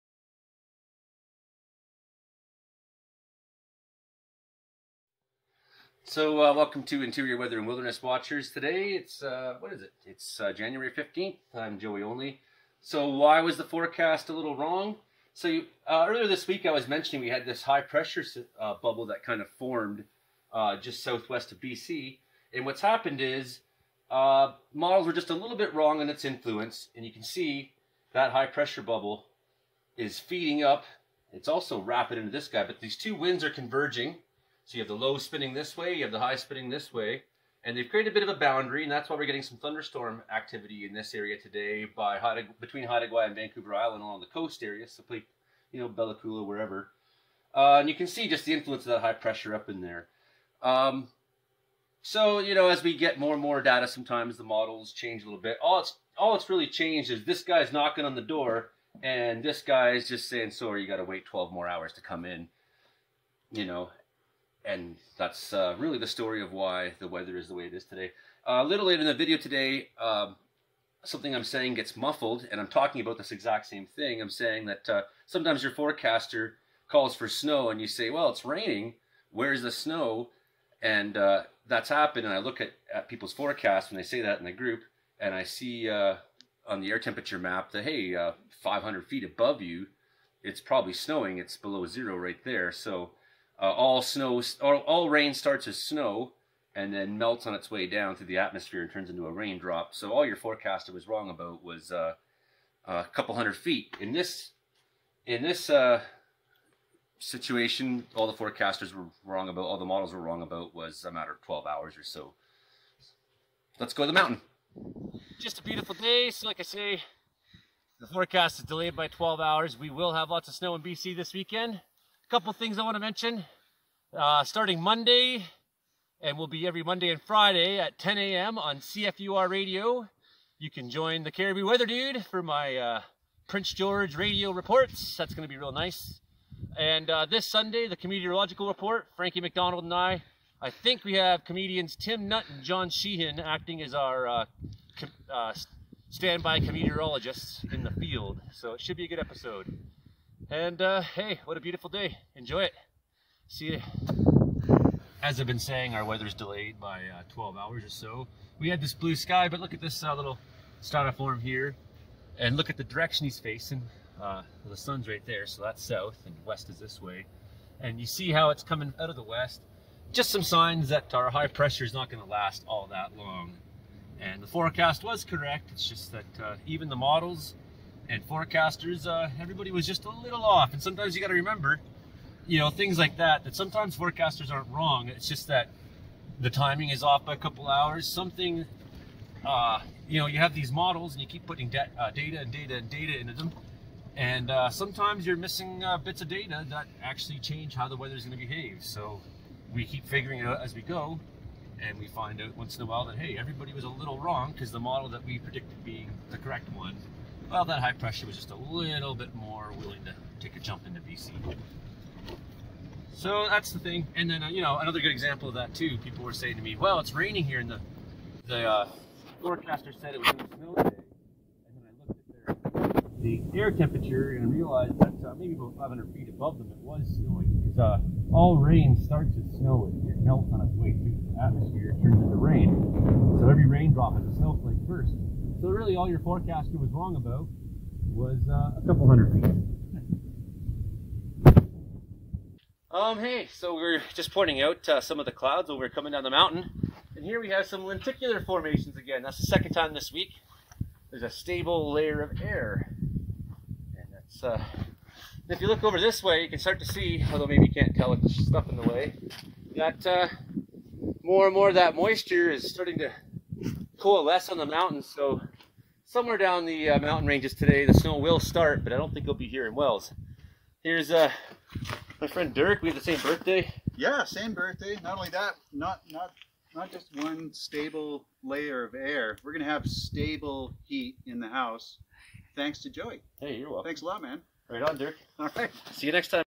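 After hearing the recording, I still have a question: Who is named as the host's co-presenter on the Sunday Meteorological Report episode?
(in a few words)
Frankie MacDonald.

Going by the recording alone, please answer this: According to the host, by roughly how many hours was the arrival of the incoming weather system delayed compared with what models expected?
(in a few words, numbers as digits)
12 hours.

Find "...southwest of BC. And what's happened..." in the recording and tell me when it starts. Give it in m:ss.
0:21.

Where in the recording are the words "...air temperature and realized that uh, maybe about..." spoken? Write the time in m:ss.
3:43.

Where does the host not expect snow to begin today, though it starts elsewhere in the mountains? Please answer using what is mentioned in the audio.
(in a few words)
Wells.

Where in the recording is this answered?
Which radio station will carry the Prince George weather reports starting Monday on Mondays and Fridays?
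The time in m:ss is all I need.
2:08.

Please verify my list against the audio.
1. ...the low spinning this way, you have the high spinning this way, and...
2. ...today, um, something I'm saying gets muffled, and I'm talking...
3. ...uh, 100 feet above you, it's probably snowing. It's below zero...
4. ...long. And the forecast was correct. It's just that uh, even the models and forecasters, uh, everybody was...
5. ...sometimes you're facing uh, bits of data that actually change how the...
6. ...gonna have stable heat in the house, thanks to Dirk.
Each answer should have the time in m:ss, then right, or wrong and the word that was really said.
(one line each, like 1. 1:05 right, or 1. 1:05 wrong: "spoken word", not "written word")
1. 0:34 right
2. 1:09 right
3. 1:28 wrong: "500", not "100"
4. 2:53 right
5. 3:14 wrong: "missing", not "facing"
6. 4:39 wrong: "Joey", not "Dirk".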